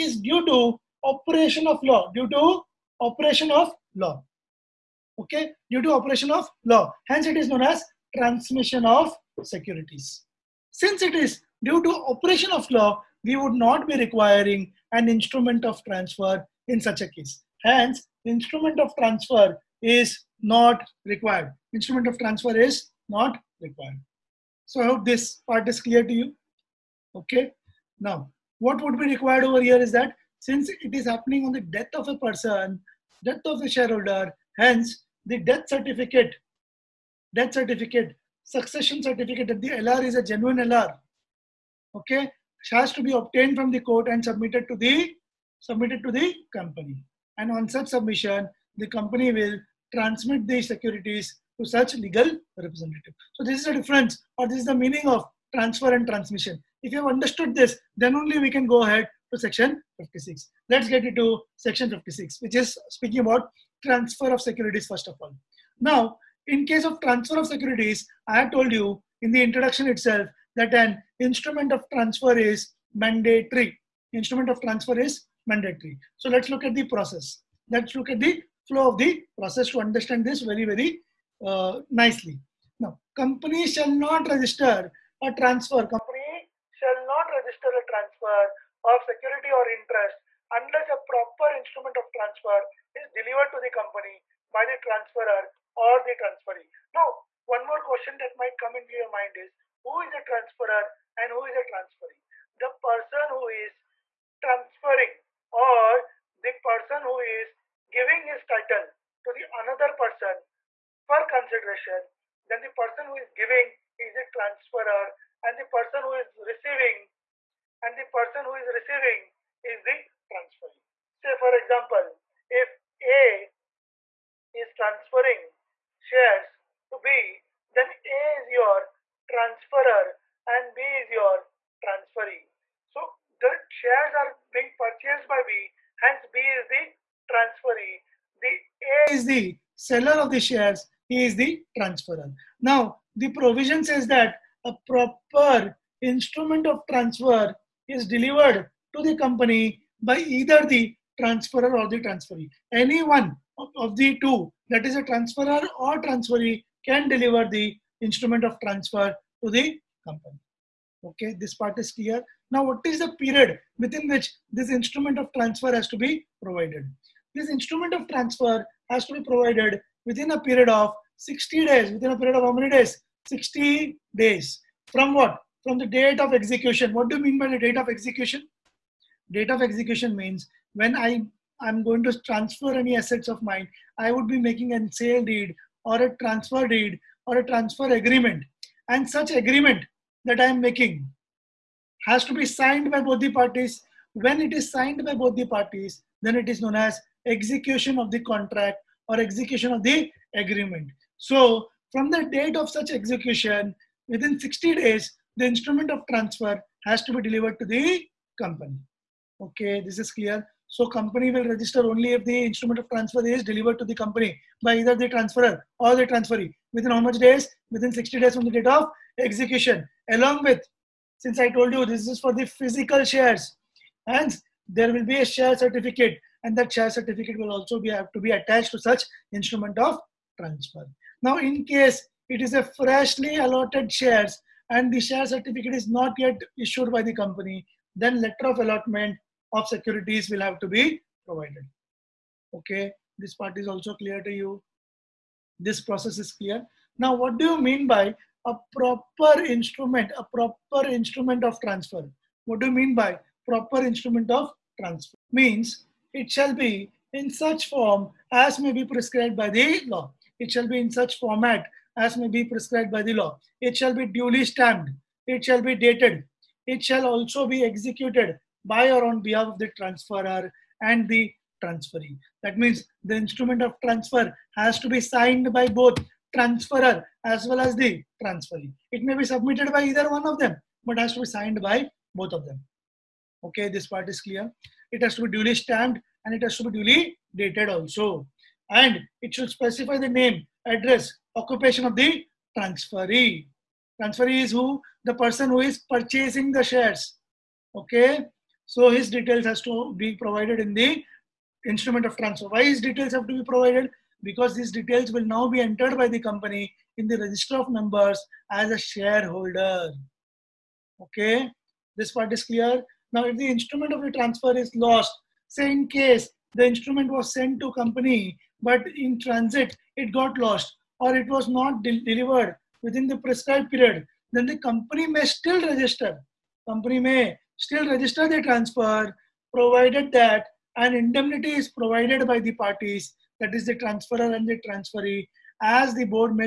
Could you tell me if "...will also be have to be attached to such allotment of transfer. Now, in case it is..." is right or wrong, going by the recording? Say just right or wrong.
wrong.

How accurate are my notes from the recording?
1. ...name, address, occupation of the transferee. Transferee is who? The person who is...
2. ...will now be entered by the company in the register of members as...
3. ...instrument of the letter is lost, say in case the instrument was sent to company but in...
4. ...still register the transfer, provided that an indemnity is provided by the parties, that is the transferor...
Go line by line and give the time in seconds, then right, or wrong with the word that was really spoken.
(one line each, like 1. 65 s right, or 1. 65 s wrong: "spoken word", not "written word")
1. 290 s right
2. 305 s right
3. 313 s wrong: "transfer", not "letter"
4. 327 s right.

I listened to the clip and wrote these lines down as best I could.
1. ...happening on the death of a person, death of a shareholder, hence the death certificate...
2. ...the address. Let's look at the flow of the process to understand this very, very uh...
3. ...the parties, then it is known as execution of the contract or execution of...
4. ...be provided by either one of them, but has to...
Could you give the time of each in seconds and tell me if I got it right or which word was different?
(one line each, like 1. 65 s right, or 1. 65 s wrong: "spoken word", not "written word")
1. 31 s right
2. 76 s wrong: "process", not "address"
3. 195 s right
4. 279 s wrong: "submitted", not "provided".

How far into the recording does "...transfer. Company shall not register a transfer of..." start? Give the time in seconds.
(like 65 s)
85 s.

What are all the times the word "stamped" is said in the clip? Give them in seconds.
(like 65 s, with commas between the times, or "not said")
264 s, 285 s.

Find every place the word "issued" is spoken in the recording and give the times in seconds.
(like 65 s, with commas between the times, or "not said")
236 s.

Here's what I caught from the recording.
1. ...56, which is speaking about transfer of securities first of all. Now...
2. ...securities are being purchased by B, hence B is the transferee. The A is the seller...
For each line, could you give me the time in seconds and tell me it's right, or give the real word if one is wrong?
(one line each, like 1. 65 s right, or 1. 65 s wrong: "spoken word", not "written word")
1. 61 s right
2. 133 s wrong: "shares", not "securities".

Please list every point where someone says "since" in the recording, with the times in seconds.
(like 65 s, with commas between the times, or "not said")
10 s, 30 s, 221 s.